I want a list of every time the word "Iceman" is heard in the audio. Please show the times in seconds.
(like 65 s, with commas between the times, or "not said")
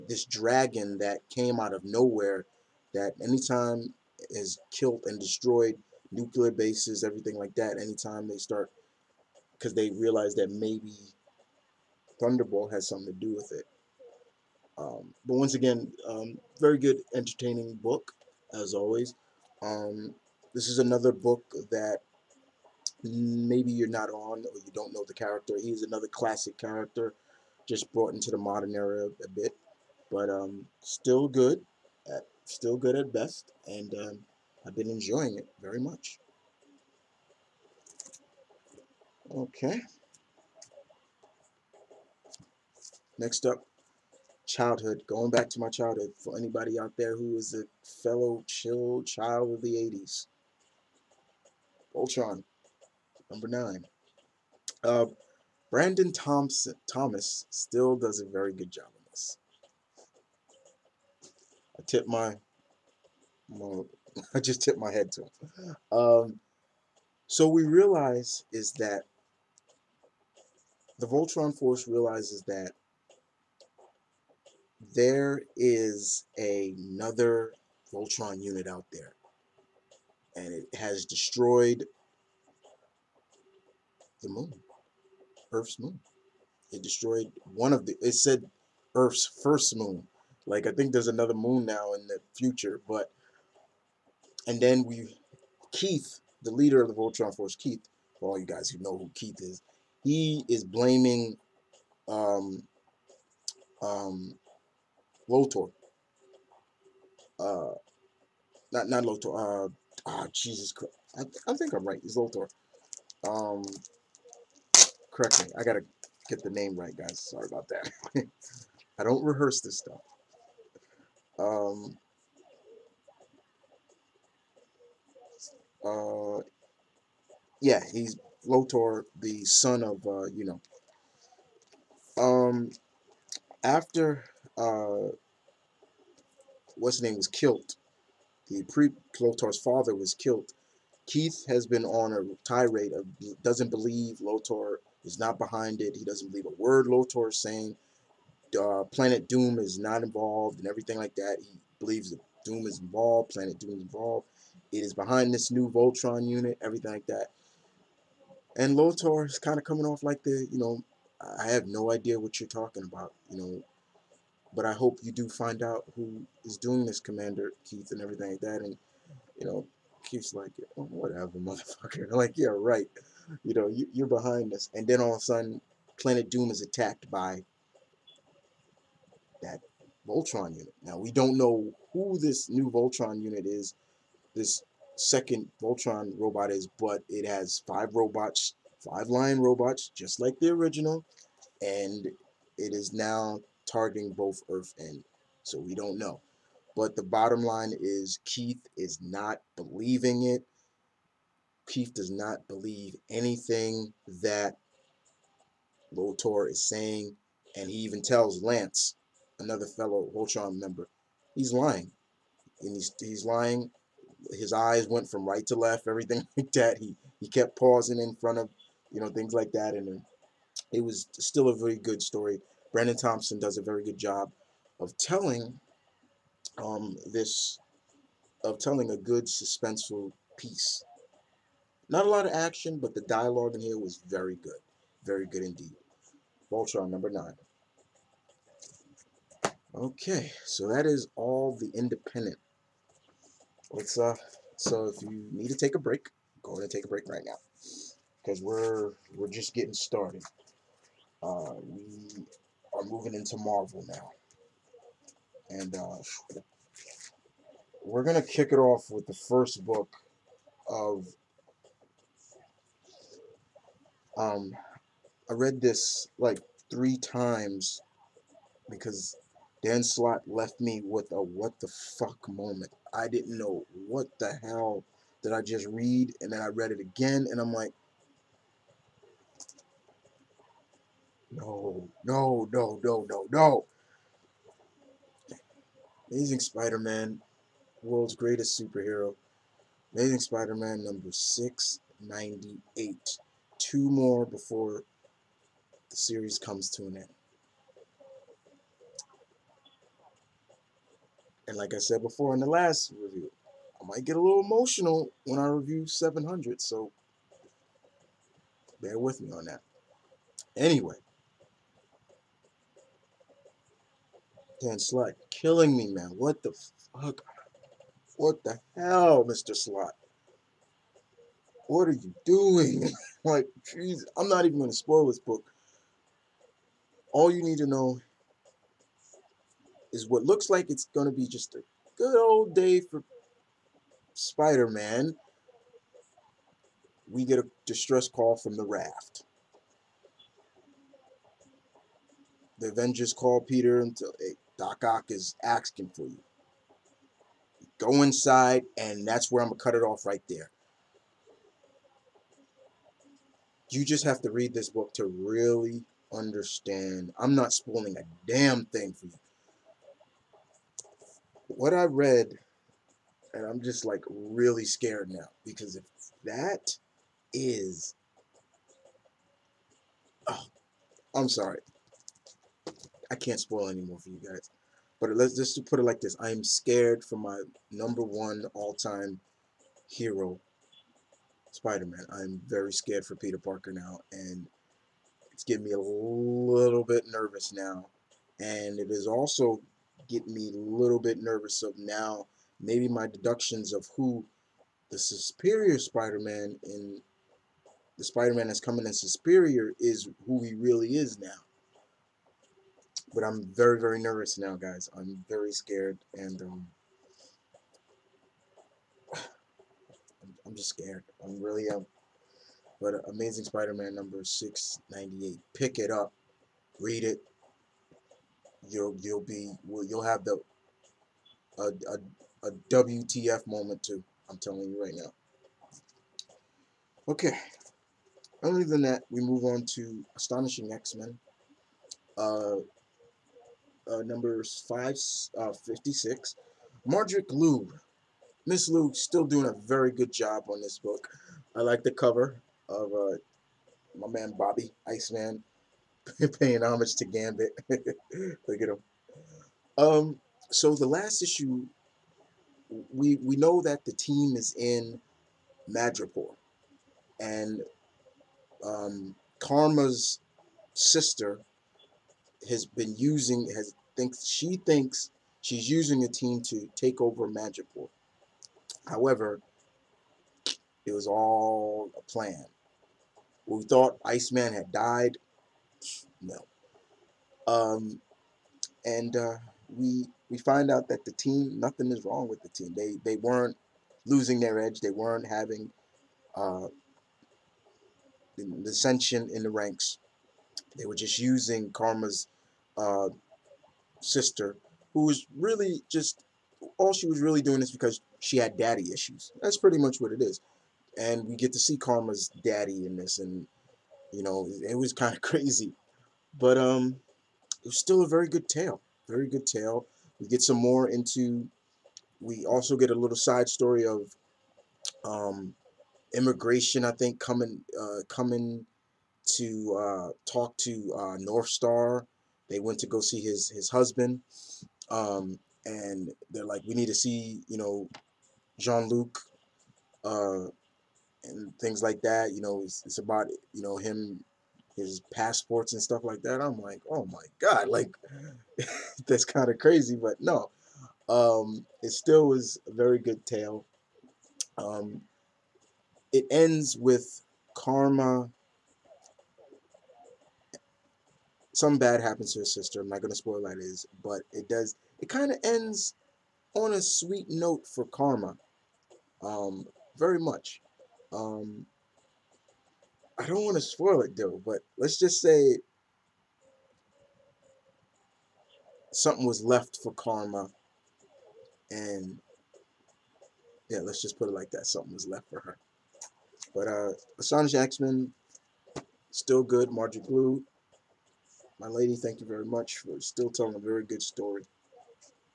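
444 s, 474 s.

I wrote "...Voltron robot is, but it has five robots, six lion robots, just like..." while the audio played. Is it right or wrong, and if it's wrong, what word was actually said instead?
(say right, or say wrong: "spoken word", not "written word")
wrong: "five", not "six".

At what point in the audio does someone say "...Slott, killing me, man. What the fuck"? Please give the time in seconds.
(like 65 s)
314 s.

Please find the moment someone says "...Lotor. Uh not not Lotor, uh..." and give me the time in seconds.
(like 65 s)
105 s.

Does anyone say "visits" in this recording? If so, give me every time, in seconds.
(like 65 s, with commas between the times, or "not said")
not said.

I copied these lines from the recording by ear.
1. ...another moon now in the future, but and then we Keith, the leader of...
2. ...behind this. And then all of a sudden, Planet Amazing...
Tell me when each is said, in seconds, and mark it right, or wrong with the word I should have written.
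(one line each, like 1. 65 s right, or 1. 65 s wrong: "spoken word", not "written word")
1. 91 s right
2. 174 s wrong: "Doom", not "Amazing".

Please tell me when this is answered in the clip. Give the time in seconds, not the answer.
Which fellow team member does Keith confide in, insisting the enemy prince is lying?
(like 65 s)
208 s.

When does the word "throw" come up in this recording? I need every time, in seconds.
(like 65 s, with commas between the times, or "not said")
not said.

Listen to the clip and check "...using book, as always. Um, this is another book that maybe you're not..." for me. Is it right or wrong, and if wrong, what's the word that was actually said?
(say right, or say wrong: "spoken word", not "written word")
wrong: "entertaining", not "using".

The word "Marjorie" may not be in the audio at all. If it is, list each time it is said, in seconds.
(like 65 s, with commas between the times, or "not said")
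436 s, 579 s.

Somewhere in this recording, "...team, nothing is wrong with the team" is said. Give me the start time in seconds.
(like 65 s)
481 s.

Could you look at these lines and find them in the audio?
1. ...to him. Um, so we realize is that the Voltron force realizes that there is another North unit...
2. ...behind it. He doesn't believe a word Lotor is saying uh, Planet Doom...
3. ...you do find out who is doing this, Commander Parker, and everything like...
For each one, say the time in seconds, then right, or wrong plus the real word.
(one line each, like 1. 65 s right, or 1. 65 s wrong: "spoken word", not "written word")
1. 65 s wrong: "Voltron", not "North"
2. 145 s right
3. 165 s wrong: "Keith", not "Parker".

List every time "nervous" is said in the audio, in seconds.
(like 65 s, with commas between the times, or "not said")
387 s, 391 s, 404 s.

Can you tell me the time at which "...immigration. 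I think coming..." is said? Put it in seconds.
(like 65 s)
516 s.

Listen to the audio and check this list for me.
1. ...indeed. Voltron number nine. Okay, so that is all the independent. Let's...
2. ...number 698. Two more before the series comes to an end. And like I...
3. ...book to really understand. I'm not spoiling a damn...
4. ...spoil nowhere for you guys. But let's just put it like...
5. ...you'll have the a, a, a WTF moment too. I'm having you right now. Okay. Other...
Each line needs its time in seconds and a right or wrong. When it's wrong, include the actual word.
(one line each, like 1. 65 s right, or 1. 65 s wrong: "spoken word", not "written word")
1. 235 s right
2. 290 s right
3. 354 s right
4. 373 s wrong: "anymore", not "nowhere"
5. 419 s wrong: "telling", not "having".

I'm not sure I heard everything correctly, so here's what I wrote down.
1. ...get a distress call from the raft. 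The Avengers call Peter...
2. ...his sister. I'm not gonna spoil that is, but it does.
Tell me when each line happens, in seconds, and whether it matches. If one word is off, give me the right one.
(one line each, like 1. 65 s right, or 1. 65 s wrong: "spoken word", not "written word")
1. 337 s right
2. 552 s right.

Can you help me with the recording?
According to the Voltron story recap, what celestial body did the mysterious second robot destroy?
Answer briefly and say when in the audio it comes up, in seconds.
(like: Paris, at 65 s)
Earth's moon, at 85 s.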